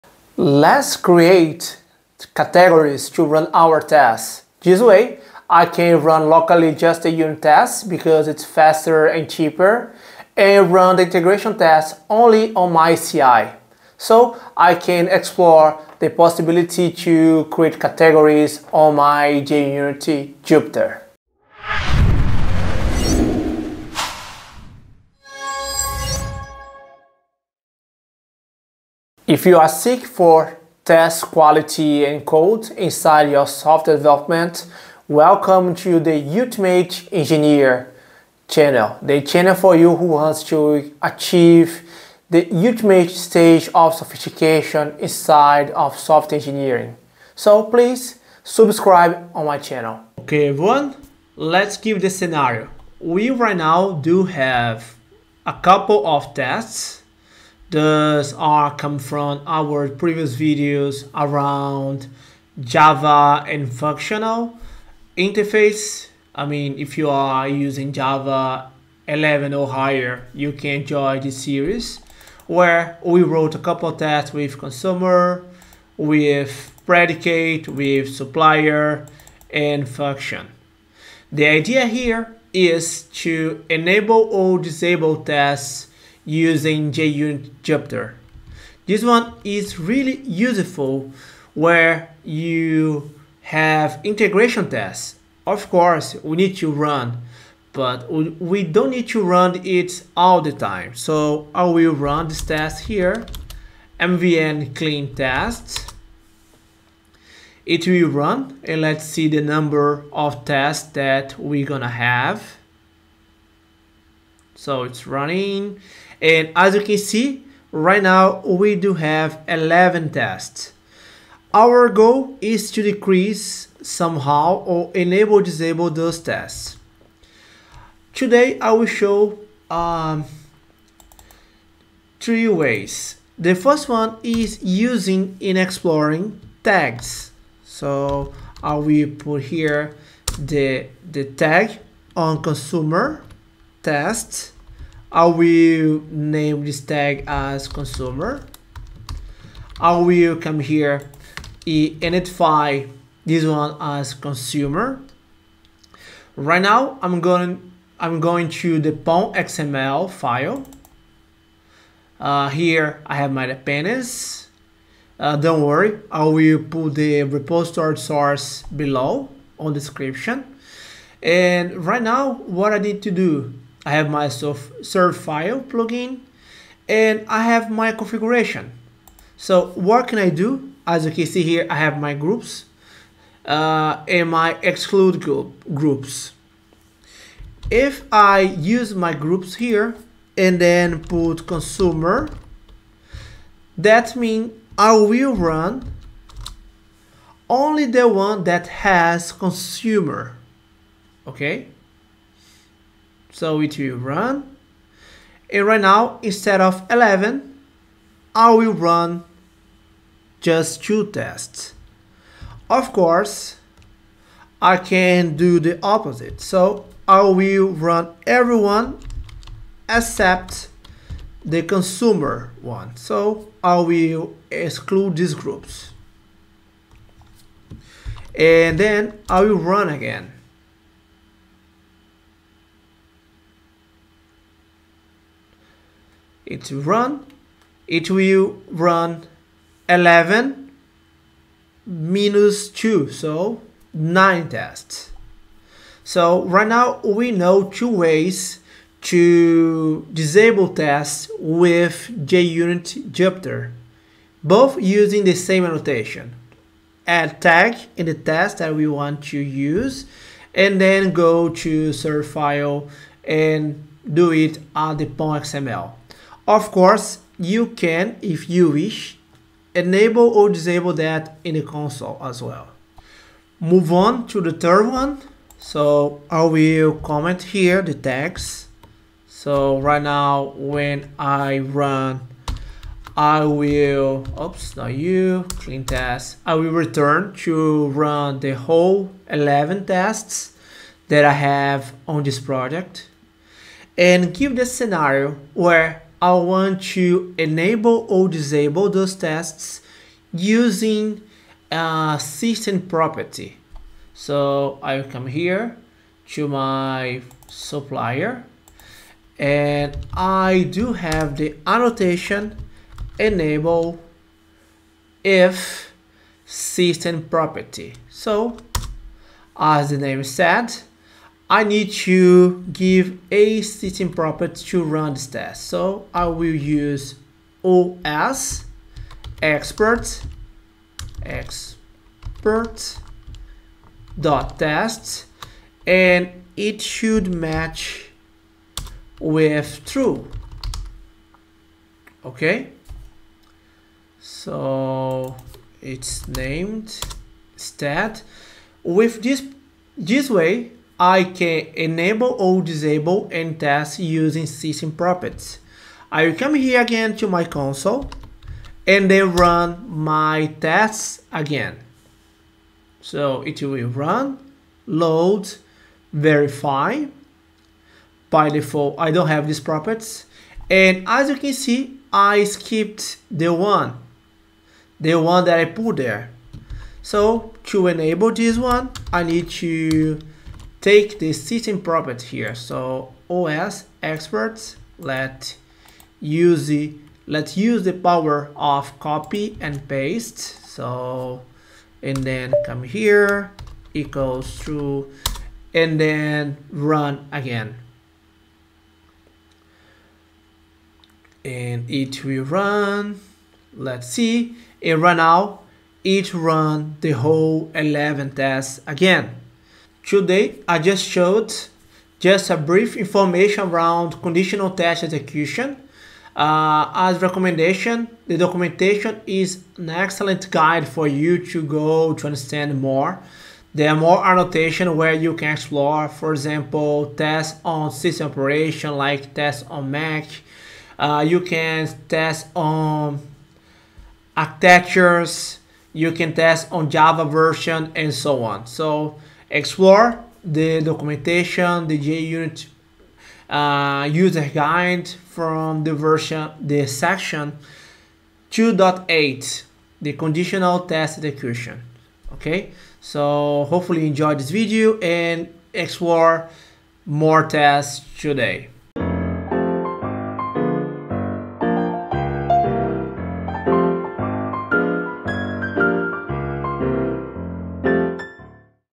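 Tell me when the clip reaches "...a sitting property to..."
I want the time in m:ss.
5:23.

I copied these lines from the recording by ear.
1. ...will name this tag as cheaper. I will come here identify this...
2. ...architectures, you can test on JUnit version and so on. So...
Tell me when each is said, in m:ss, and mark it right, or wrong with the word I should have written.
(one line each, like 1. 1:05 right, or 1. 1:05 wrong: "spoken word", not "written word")
1. 2:25 wrong: "consumer", not "cheaper"
2. 7:14 wrong: "Java", not "JUnit".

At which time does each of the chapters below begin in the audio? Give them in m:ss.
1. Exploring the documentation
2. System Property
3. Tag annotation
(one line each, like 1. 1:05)
1. 7:01
2. 5:10
3. 2:11.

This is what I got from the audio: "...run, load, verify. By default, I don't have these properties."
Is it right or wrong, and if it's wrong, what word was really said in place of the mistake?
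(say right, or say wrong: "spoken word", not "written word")
right.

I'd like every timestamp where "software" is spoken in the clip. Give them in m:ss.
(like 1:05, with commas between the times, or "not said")
0:33, 0:45.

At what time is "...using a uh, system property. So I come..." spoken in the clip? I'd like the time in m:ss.
5:00.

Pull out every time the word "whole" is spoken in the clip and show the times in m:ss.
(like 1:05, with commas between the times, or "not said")
4:48, 6:47.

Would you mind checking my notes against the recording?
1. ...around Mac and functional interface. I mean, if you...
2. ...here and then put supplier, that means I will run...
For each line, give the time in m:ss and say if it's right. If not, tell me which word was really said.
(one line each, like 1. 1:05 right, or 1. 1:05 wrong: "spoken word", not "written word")
1. 1:01 wrong: "Java", not "Mac"
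2. 3:09 wrong: "consumer", not "supplier".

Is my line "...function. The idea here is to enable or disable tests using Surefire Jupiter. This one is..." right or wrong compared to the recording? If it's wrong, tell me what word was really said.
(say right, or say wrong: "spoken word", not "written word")
wrong: "JUnit", not "Surefire".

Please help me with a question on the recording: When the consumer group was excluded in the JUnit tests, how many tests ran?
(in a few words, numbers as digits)
9.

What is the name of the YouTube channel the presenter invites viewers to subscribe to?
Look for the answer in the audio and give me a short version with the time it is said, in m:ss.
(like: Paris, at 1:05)
Ultimate Engineer, at 0:36.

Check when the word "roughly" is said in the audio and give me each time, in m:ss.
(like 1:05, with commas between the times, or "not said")
not said.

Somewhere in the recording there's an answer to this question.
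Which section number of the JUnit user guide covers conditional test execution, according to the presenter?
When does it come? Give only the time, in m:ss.
7:28.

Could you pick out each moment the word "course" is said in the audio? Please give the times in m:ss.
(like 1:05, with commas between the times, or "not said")
1:35, 3:32, 4:26.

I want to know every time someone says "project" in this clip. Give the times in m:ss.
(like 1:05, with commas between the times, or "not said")
4:52.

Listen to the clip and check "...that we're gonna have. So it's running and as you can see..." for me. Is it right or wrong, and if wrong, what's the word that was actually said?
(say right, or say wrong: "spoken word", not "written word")
right.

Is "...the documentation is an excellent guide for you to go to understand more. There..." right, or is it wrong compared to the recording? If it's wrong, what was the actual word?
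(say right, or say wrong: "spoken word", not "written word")
right.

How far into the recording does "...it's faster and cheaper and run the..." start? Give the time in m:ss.
0:08.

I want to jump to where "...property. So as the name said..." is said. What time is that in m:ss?
5:17.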